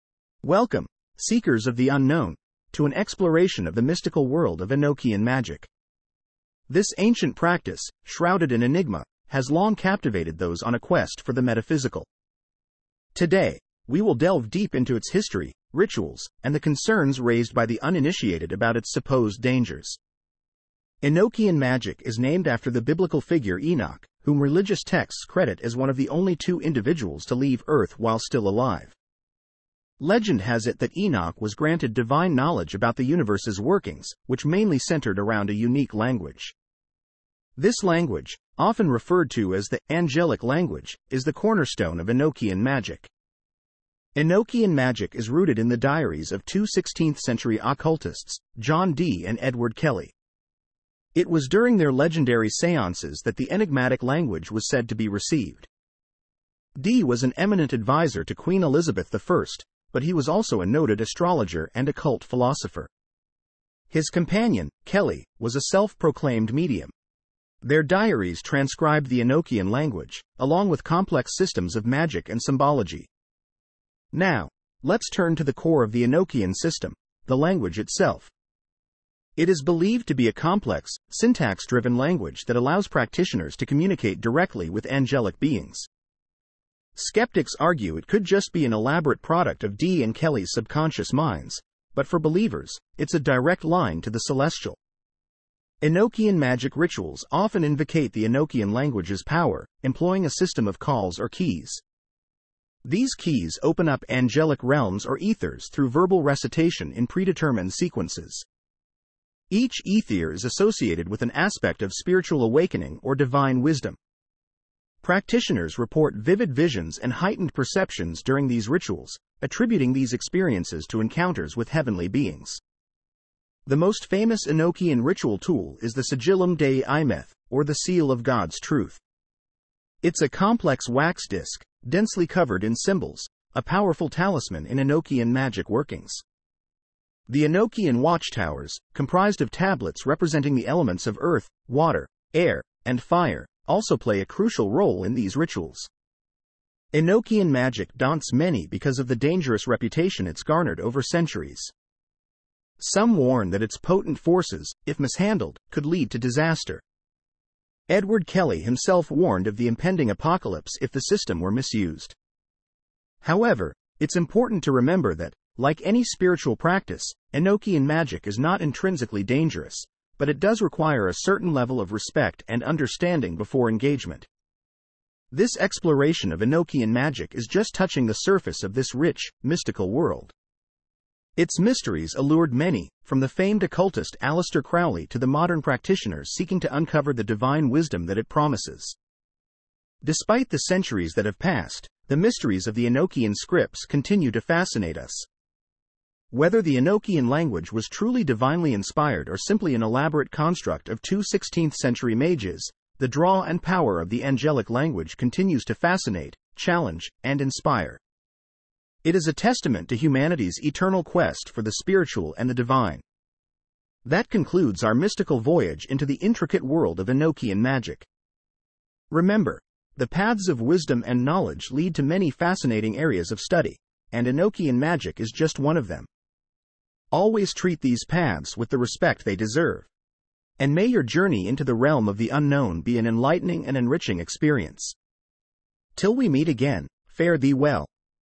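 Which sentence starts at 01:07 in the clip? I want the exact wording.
Their diaries transcribe the Enochian language, along with complex systems of magic and symbology.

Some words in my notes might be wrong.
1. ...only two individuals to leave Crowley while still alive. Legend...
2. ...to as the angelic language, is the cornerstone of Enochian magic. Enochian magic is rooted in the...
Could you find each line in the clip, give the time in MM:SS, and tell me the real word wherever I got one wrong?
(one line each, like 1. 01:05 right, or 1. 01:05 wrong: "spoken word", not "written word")
1. 00:26 wrong: "Earth", not "Crowley"
2. 00:39 right.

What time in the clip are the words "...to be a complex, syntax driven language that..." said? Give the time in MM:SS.
01:20.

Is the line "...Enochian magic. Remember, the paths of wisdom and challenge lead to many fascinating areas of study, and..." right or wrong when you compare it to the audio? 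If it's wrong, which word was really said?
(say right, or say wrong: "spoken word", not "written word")
wrong: "knowledge", not "challenge".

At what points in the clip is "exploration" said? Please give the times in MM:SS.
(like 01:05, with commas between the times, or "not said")
00:02, 02:55.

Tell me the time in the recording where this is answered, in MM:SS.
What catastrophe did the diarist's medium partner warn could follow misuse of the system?
02:39.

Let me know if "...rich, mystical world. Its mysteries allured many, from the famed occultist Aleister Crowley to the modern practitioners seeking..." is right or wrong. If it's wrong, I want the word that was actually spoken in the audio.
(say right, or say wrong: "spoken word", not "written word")
right.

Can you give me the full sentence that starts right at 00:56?
Dee was an eminent advisor to Queen Elizabeth I, but he was also a noted astrologer and occult philosopher.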